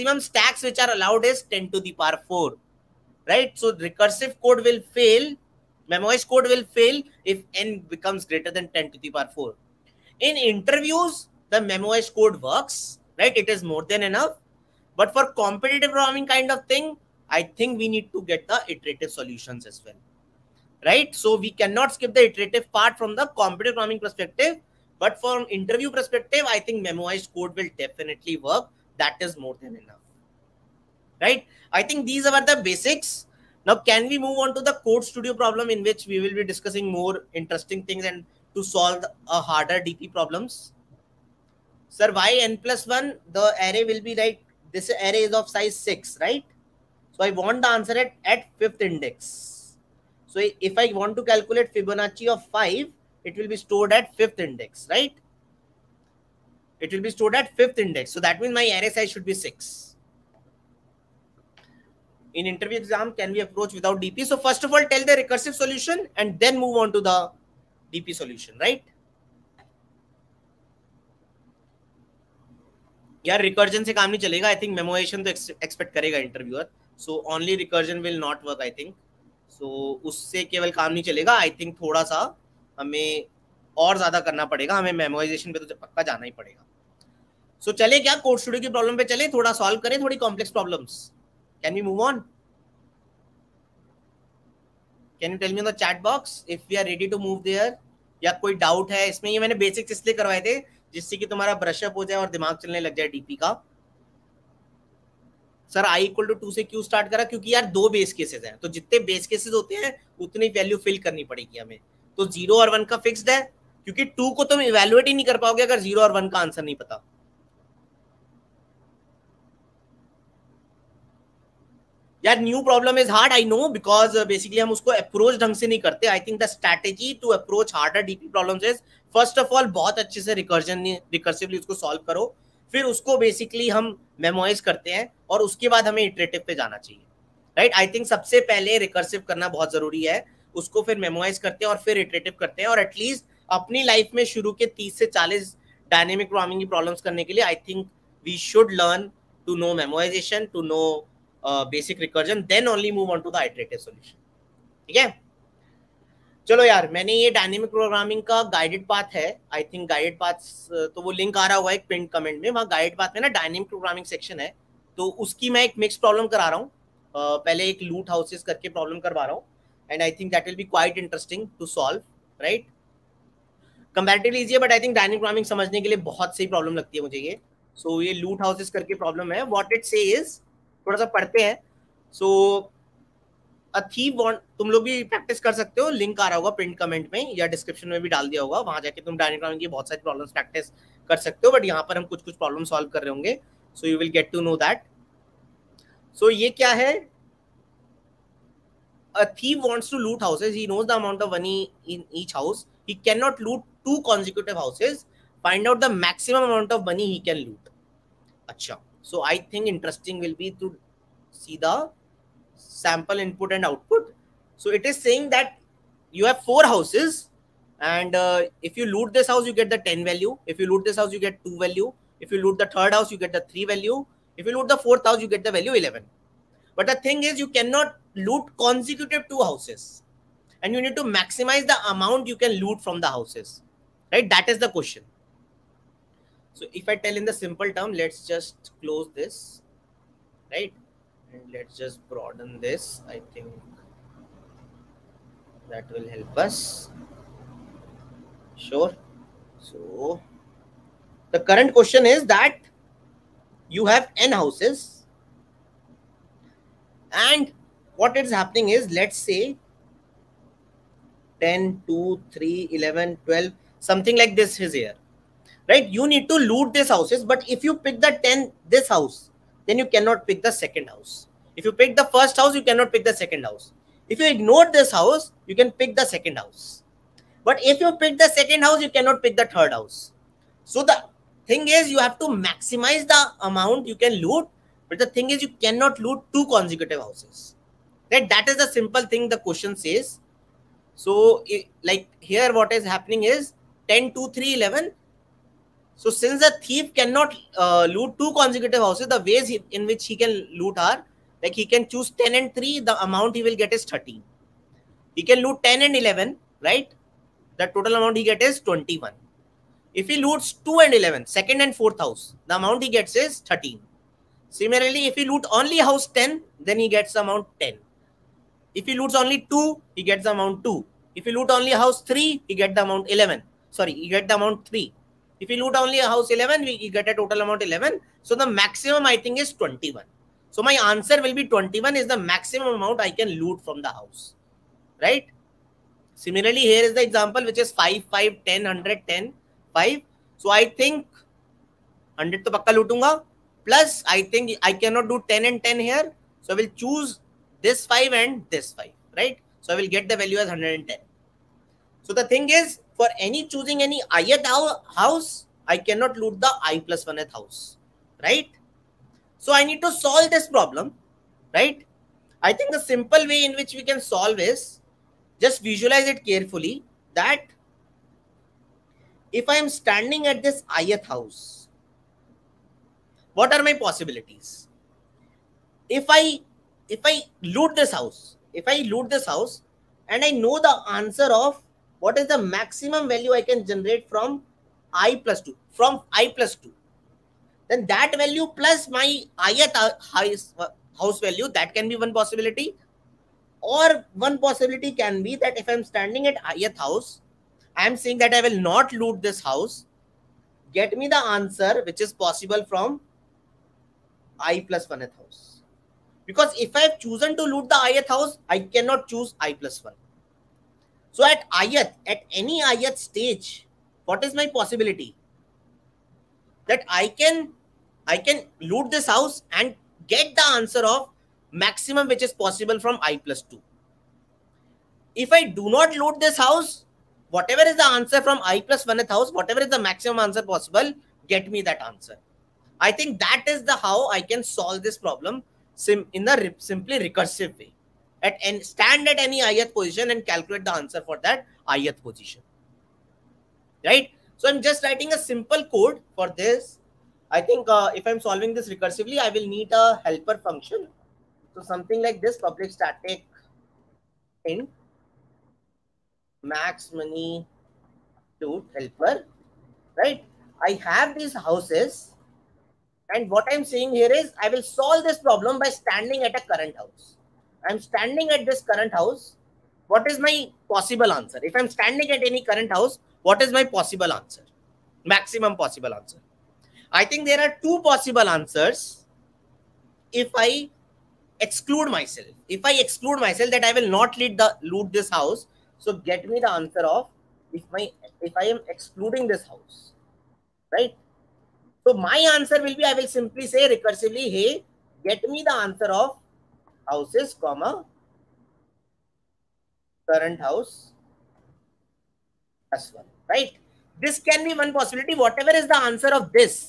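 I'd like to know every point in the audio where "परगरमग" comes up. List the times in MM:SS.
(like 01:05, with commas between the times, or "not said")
02:26, 02:37, 02:43, 02:55.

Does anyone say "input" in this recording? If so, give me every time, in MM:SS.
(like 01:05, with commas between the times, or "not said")
03:33.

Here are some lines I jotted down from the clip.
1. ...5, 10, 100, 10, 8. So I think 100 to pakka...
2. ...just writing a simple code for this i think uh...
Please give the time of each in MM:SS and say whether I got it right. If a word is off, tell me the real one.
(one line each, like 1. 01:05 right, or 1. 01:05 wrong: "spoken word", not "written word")
1. 05:38 wrong: "5", not "8"
2. 07:24 right.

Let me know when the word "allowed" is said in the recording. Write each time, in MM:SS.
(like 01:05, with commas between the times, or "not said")
00:00.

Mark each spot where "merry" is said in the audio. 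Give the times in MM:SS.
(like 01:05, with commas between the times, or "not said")
not said.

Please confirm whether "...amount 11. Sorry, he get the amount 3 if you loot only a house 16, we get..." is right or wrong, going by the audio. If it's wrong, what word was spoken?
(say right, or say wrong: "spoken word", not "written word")
wrong: "11", not "16".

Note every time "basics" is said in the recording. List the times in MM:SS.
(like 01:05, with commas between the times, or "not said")
00:32.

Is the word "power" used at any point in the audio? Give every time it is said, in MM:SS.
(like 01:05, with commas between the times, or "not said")
00:02, 00:09.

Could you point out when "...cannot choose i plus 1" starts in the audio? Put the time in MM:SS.
06:48.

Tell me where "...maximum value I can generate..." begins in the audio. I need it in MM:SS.
06:22.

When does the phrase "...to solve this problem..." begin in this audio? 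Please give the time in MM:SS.
05:59.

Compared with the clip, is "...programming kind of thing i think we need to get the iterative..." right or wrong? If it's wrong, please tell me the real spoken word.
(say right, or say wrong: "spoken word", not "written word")
right.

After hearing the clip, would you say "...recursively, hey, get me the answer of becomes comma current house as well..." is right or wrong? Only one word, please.
wrong.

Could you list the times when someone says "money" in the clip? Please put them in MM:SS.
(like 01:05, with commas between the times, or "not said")
03:21, 03:26, 07:36.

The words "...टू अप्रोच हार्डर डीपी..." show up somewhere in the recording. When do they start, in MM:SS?
02:07.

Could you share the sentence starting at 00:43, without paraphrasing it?
The array will be like, this array is of size 6, right?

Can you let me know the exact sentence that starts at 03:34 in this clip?
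So it is saying that you have four houses and uh, if you loot this house, you get the 10 value.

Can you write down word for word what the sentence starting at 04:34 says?
If you ignore this house, you can pick the second house.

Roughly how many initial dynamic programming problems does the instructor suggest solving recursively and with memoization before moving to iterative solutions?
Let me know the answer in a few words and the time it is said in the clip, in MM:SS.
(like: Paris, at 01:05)
30 to 40, at 02:24.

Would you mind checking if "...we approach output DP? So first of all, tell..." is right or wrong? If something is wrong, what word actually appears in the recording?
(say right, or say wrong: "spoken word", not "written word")
wrong: "without", not "output".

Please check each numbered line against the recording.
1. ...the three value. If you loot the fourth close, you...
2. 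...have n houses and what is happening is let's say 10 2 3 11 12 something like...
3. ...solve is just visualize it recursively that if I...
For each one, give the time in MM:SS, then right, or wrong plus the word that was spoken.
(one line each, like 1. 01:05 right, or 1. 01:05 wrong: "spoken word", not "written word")
1. 03:43 wrong: "house", not "close"
2. 04:13 right
3. 06:03 wrong: "carefully", not "recursively".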